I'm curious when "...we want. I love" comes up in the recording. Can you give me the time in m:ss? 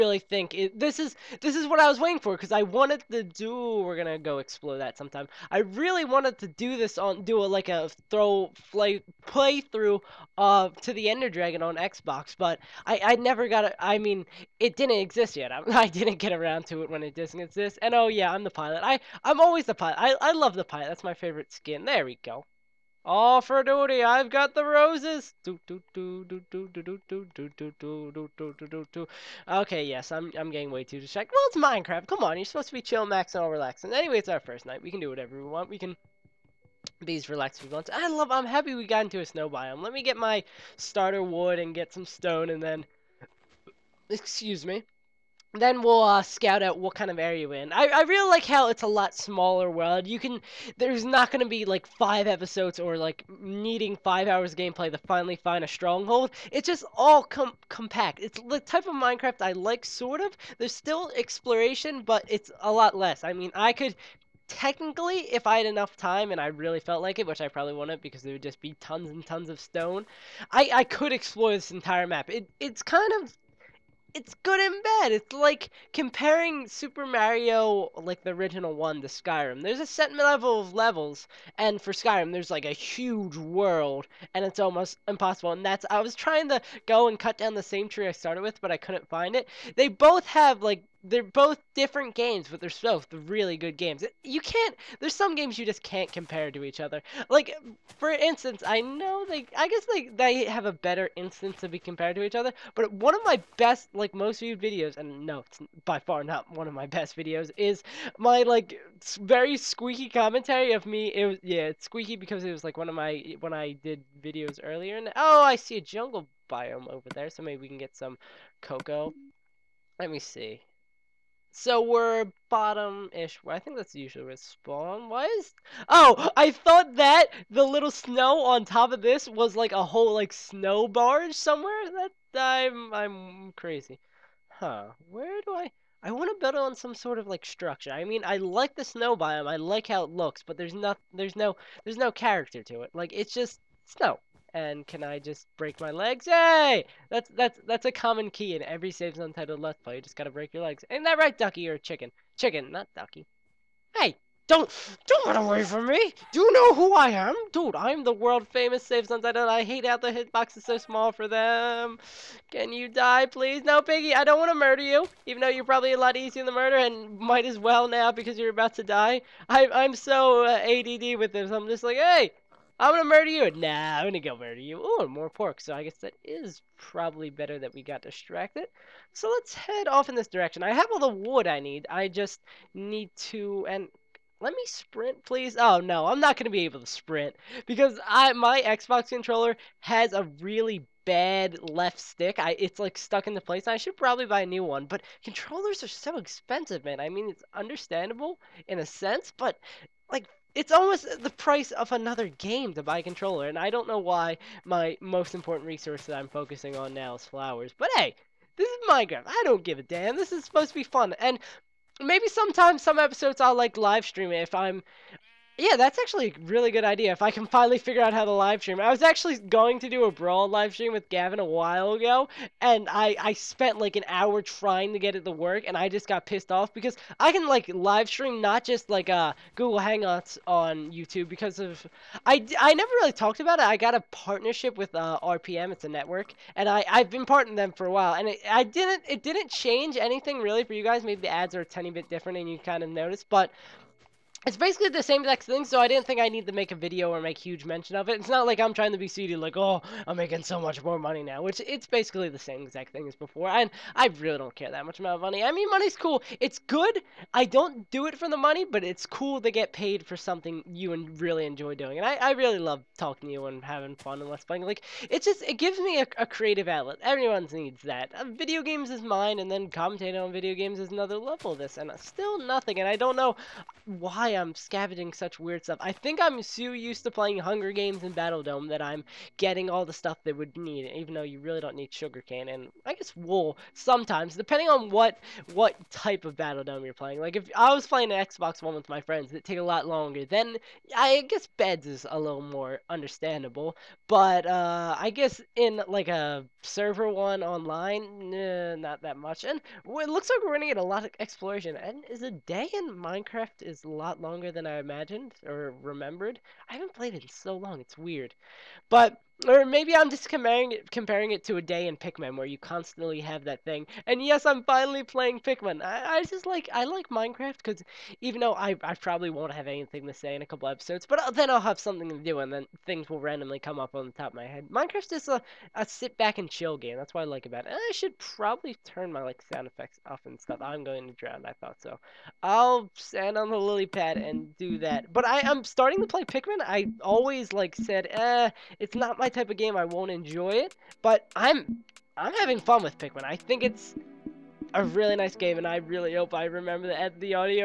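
0:37.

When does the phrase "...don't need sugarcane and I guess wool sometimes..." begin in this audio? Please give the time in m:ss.
4:41.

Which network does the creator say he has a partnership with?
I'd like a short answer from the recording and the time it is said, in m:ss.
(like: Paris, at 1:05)
RPM, at 3:55.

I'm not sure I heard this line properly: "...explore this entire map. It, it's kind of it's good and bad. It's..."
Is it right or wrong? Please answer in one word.
right.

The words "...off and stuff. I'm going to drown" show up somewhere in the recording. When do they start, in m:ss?
5:30.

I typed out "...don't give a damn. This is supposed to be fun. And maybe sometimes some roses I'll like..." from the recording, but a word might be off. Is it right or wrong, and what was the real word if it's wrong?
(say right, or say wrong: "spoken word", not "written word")
wrong: "episodes", not "roses".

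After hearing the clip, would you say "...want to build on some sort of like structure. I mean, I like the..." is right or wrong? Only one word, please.
right.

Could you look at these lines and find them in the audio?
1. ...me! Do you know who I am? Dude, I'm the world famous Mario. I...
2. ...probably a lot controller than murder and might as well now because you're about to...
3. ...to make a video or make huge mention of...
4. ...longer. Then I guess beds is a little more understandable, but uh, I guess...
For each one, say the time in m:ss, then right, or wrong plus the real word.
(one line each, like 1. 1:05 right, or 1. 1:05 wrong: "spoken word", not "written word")
1. 2:35 wrong: "SaveAsUntitled", not "Mario"
2. 2:45 wrong: "easier", not "controller"
3. 4:06 right
4. 4:49 right.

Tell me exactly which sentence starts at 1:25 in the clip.
And that's I was trying to go and cut down the same tree I started with, but I couldn't find it.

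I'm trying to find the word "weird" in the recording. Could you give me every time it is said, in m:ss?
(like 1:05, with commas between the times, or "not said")
4:35, 5:07.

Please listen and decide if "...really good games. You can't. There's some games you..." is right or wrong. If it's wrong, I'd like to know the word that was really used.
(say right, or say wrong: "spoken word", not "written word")
right.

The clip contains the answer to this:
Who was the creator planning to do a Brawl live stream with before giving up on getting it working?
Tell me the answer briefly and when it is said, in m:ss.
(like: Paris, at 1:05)
Gavin, at 3:41.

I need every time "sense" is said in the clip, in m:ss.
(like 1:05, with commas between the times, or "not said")
3:18.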